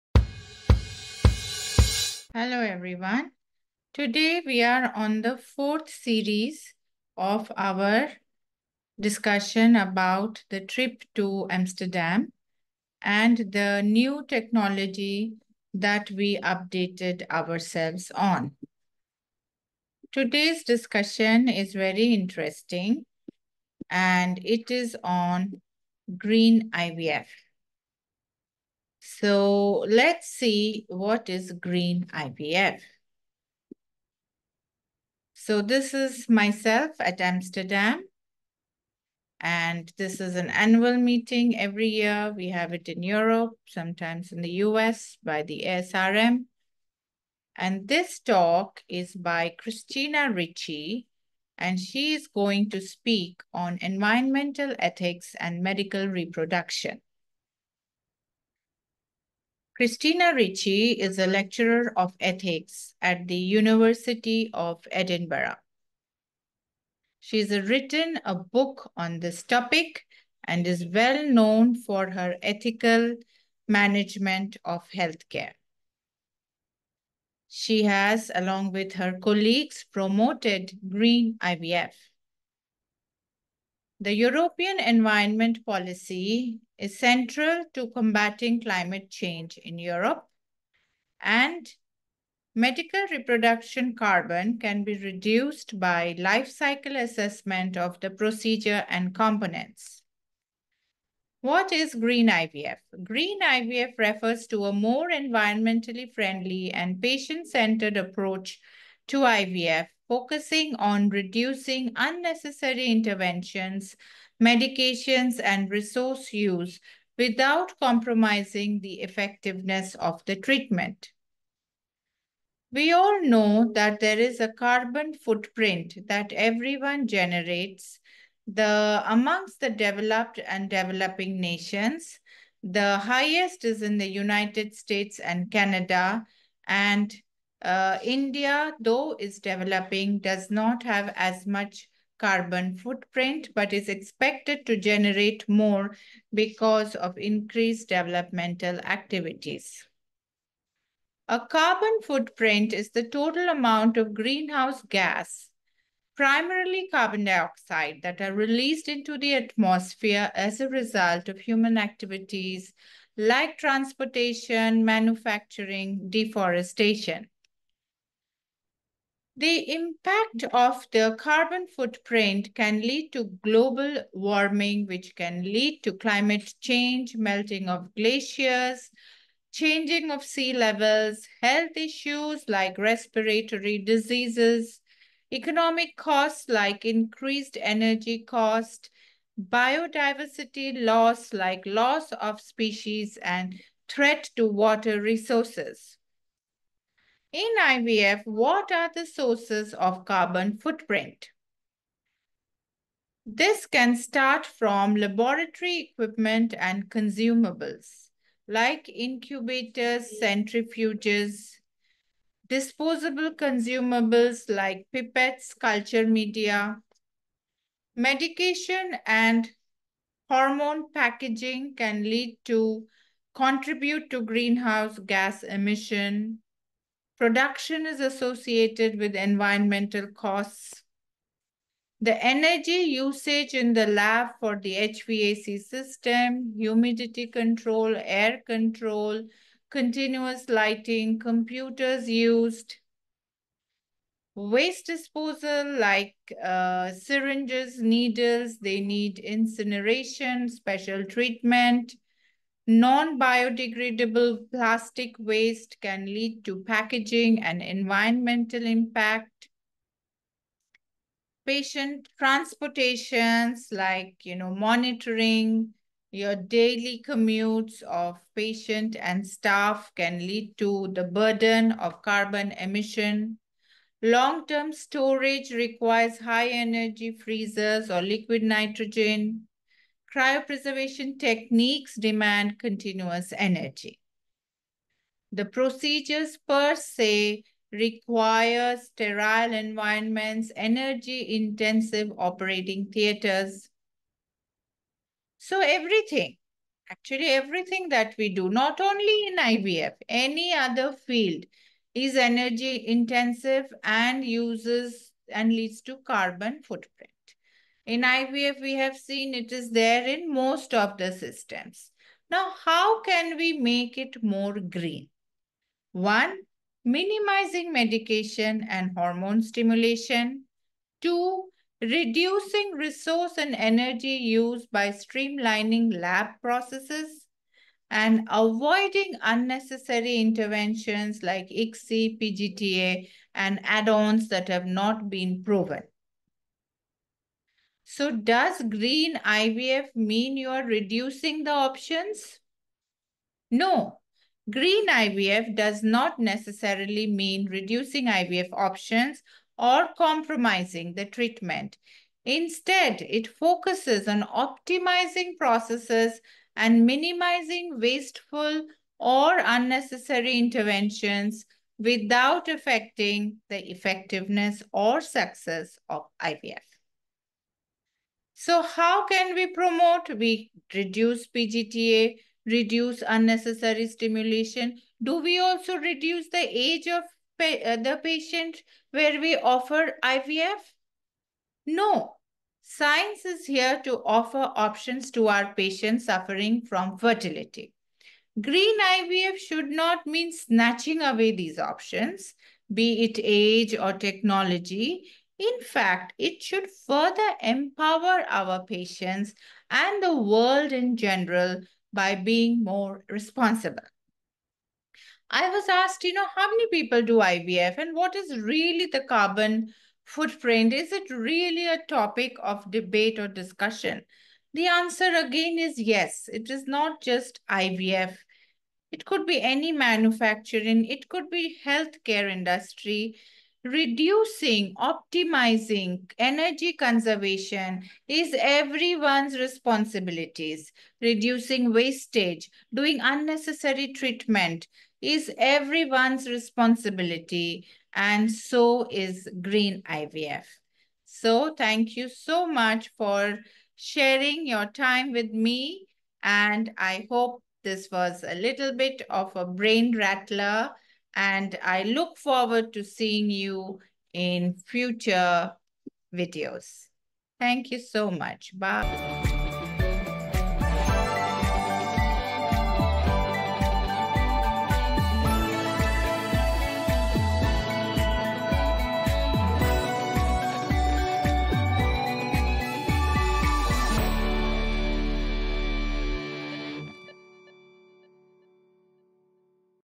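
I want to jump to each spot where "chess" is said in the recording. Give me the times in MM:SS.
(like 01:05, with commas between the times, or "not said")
not said.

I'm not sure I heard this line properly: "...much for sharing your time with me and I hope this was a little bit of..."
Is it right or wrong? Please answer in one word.
right.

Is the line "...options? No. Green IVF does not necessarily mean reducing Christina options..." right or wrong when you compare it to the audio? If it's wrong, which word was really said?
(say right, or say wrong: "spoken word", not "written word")
wrong: "IVF", not "Christina".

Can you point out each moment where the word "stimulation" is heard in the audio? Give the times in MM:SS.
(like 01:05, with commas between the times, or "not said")
05:19, 06:13.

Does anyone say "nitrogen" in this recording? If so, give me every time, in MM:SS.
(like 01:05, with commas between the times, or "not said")
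04:38.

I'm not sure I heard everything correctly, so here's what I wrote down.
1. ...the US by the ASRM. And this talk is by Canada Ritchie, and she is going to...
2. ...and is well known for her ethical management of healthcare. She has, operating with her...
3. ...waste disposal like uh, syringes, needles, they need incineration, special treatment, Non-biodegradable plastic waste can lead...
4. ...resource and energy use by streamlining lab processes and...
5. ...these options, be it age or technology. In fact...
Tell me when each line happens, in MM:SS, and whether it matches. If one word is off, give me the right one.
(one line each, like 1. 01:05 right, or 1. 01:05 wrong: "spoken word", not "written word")
1. 00:44 wrong: "Christina", not "Canada"
2. 01:10 wrong: "along", not "operating"
3. 04:04 right
4. 05:22 right
5. 06:31 right.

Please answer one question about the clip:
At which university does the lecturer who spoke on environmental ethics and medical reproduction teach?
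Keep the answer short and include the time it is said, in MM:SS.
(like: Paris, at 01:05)
University of Edinburgh, at 01:03.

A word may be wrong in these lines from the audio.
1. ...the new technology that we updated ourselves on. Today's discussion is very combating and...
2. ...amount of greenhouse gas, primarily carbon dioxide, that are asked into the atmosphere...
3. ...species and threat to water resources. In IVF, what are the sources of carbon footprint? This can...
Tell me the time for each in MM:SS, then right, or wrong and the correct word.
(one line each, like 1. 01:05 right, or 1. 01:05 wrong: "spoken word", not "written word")
1. 00:13 wrong: "interesting", not "combating"
2. 02:33 wrong: "released", not "asked"
3. 03:12 right.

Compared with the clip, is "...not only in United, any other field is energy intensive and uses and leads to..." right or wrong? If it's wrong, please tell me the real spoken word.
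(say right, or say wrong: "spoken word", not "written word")
wrong: "IVF", not "United".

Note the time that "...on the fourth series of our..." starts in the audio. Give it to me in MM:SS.
00:04.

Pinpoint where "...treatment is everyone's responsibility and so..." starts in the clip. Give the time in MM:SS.
07:13.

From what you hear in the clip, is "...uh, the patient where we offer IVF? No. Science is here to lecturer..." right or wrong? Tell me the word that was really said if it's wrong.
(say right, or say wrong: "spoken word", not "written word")
wrong: "offer", not "lecturer".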